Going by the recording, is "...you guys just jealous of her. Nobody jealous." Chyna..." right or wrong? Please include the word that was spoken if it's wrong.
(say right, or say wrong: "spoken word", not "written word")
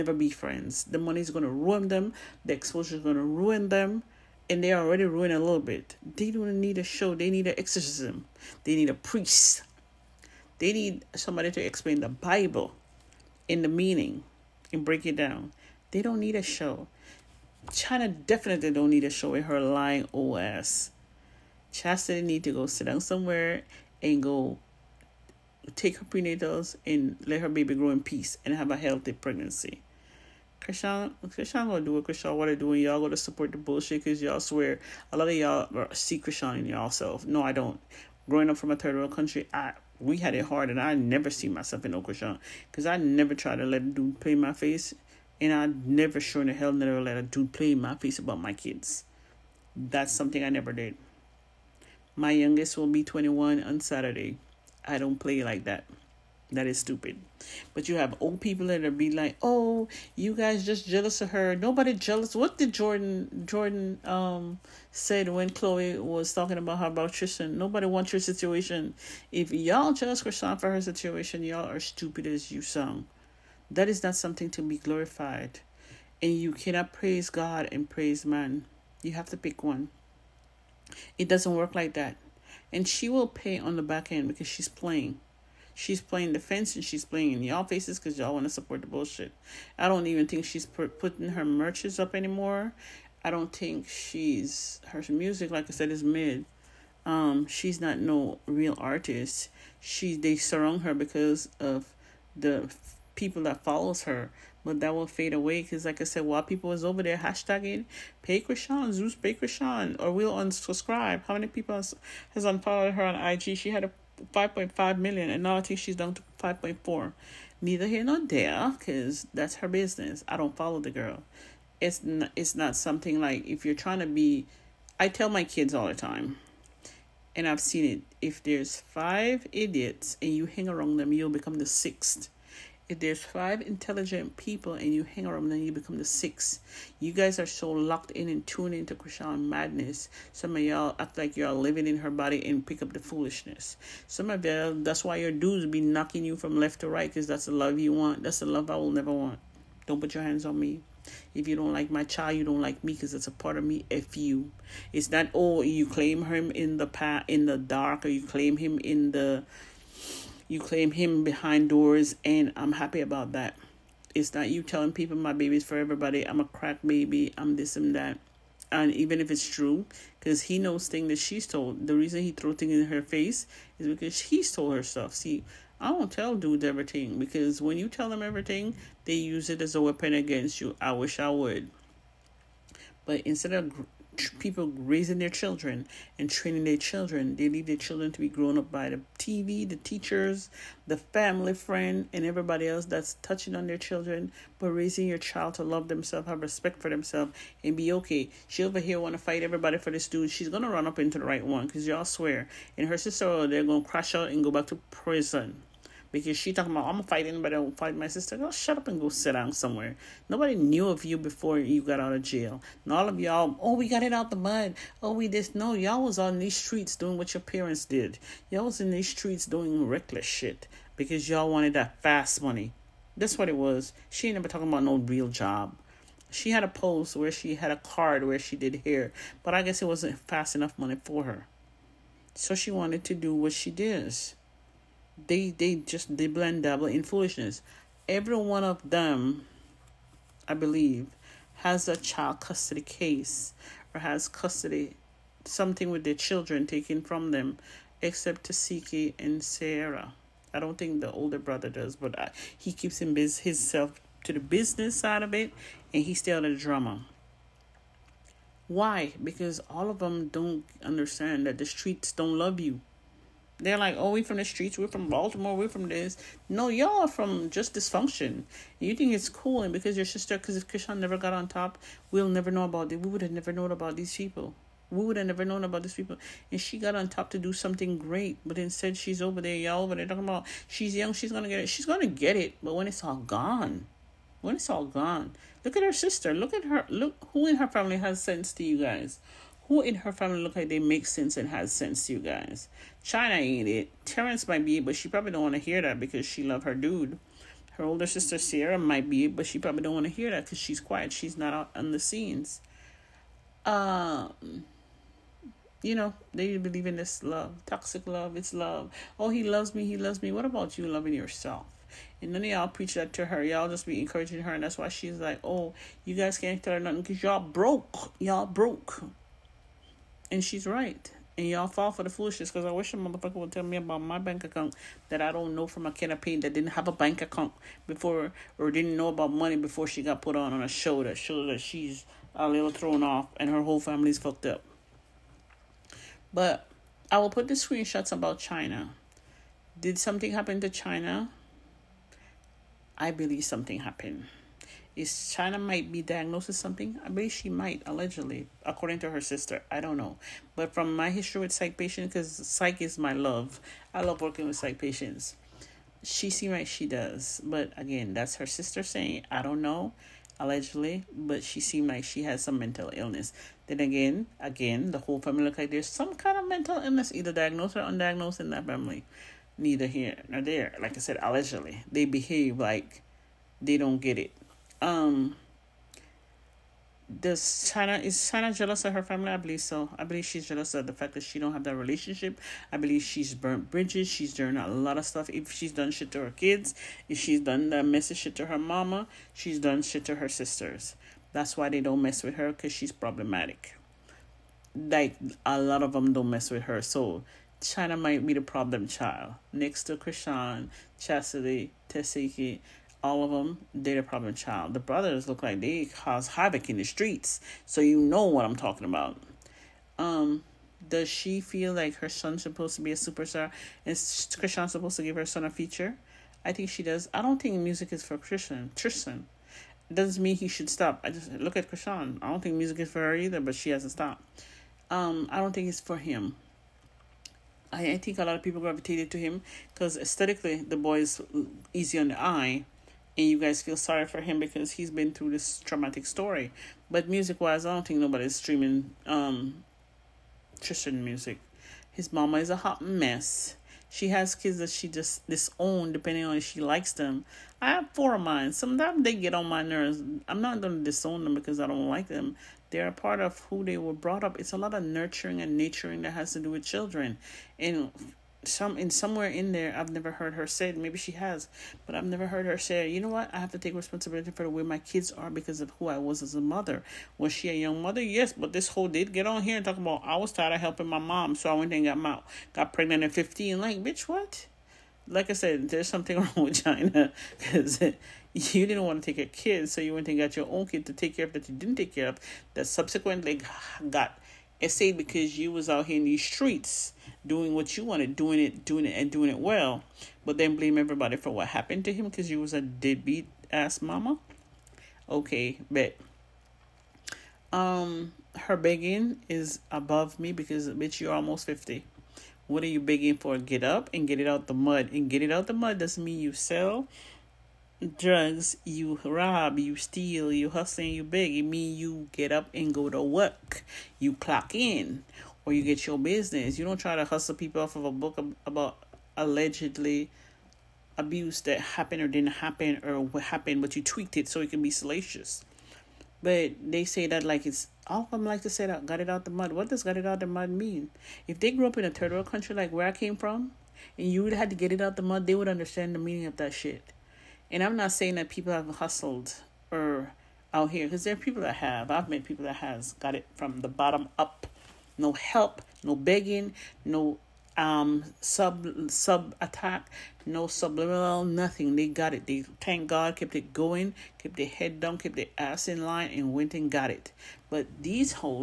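wrong: "What", not "Chyna".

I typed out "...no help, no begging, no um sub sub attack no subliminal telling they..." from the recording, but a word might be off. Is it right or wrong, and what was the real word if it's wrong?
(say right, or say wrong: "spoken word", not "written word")
wrong: "nothing", not "telling".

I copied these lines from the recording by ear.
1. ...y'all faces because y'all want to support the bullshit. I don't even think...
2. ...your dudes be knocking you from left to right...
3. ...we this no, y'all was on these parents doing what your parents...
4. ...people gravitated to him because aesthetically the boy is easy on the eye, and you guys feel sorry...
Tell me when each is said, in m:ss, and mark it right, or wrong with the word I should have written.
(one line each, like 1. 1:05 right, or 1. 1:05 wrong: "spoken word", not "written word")
1. 1:27 right
2. 2:25 right
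3. 3:35 wrong: "streets", not "parents"
4. 7:08 right.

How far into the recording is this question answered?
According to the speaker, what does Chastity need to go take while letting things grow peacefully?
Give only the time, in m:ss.
0:26.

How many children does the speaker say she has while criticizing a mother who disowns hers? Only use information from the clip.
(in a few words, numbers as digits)
4.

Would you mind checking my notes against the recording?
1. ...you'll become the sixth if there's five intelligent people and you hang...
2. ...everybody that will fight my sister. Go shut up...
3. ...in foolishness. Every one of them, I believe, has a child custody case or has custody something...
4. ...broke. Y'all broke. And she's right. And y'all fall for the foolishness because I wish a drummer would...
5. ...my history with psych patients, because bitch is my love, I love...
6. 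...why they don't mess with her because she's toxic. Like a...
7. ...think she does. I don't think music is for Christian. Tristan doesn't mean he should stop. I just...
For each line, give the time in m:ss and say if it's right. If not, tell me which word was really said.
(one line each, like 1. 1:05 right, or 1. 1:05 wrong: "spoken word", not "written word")
1. 2:11 right
2. 3:27 wrong: "anybody", not "everybody"
3. 3:56 right
4. 5:17 wrong: "motherfucker", not "drummer"
5. 5:50 wrong: "psych", not "bitch"
6. 6:31 wrong: "problematic", not "toxic"
7. 6:56 right.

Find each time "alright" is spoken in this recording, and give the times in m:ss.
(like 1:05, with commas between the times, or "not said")
not said.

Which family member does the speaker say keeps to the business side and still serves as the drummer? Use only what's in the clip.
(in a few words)
The older brother.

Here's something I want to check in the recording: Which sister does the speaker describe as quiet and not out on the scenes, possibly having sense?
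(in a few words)
Sierra.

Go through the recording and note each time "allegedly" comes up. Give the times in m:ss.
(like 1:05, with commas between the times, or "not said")
5:47, 6:00, 6:11, 8:39.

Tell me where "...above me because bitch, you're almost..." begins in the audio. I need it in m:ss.
8:19.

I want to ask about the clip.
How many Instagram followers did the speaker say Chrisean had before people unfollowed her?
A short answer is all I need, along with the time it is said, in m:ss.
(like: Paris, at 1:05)
5.5 million, at 1:54.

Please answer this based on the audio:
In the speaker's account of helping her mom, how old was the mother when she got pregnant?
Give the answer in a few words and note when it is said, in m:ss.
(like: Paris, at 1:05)
15, at 7:53.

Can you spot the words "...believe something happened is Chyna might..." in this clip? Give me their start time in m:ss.
5:43.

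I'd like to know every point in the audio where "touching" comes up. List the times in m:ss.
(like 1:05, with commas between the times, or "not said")
3:13.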